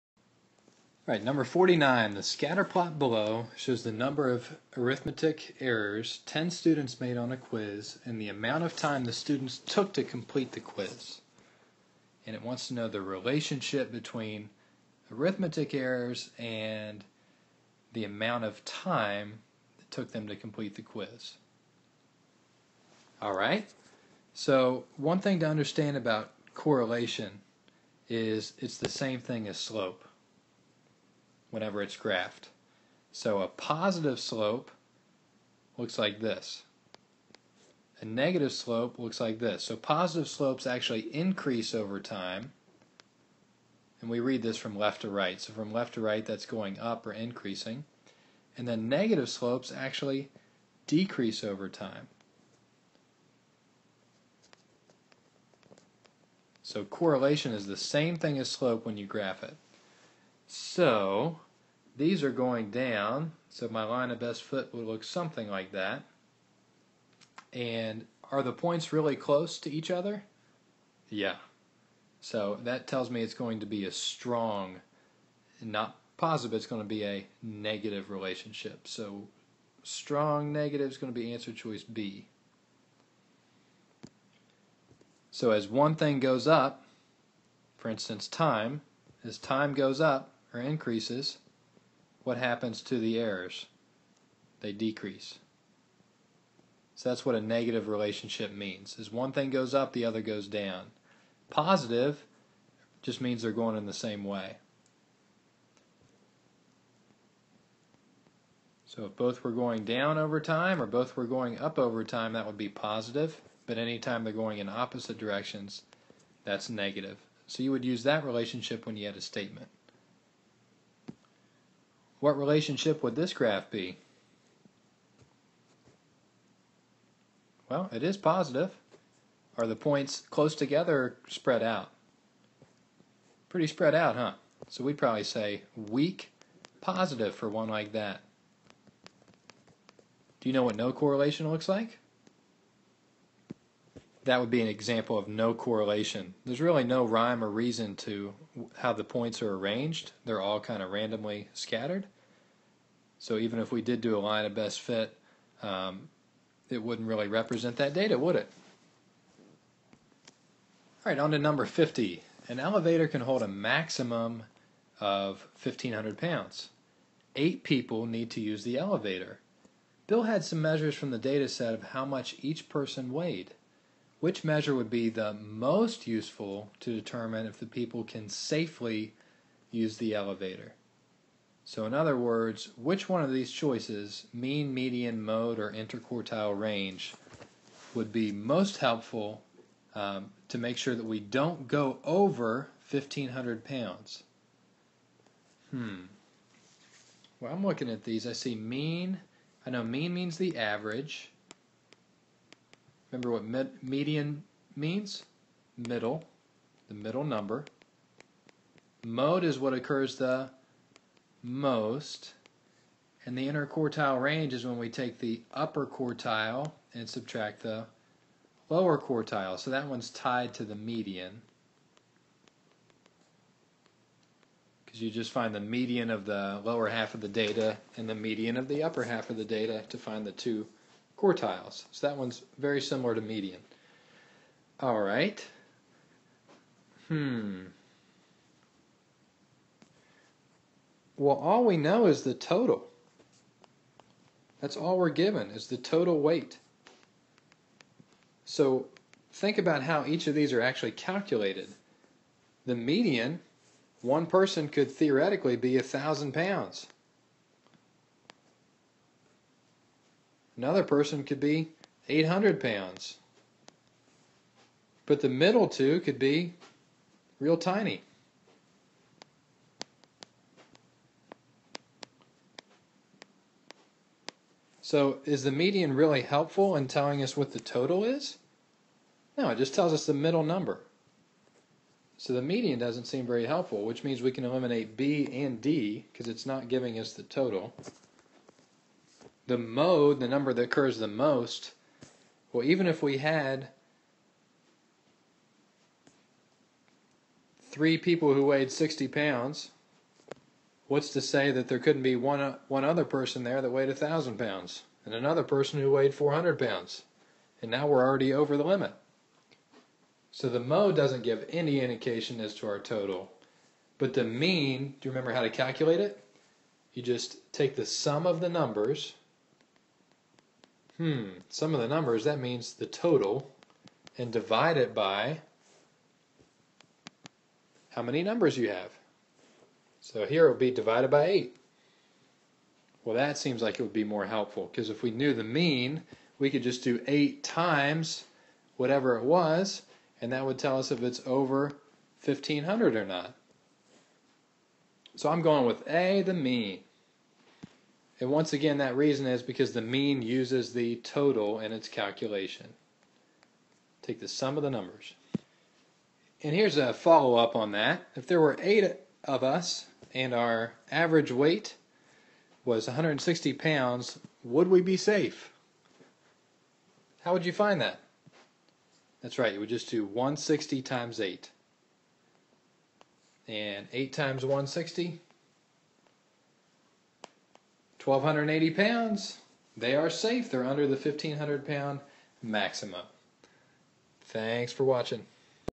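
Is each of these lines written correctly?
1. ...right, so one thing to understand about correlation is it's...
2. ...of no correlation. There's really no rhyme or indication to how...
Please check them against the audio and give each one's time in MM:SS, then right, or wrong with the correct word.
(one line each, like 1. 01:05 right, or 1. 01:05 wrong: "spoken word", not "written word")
1. 00:23 right
2. 02:25 wrong: "reason", not "indication".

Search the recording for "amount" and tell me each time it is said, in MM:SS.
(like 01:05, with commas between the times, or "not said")
00:08, 00:18.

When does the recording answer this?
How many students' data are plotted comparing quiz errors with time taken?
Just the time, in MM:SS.
00:06.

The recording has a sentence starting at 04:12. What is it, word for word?
The median, one person could theoretically be a thousand pounds.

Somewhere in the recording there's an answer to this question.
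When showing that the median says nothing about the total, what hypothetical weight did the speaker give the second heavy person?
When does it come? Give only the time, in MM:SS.
04:22.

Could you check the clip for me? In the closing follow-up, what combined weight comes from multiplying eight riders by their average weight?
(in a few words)
1,280 pounds.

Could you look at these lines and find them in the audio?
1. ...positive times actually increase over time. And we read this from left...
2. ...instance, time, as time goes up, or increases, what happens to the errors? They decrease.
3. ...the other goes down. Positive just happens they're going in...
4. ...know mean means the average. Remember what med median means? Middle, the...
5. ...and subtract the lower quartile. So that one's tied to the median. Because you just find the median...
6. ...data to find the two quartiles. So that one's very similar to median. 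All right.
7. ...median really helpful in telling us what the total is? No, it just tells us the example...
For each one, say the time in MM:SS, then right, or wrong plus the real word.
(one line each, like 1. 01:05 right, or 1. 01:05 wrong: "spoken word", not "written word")
1. 00:39 wrong: "slopes", not "times"
2. 01:27 right
3. 01:39 wrong: "means", not "happens"
4. 03:19 right
5. 03:36 right
6. 03:49 right
7. 04:35 wrong: "middle", not "example".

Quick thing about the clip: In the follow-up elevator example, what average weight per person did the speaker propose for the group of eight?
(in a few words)
160 pounds.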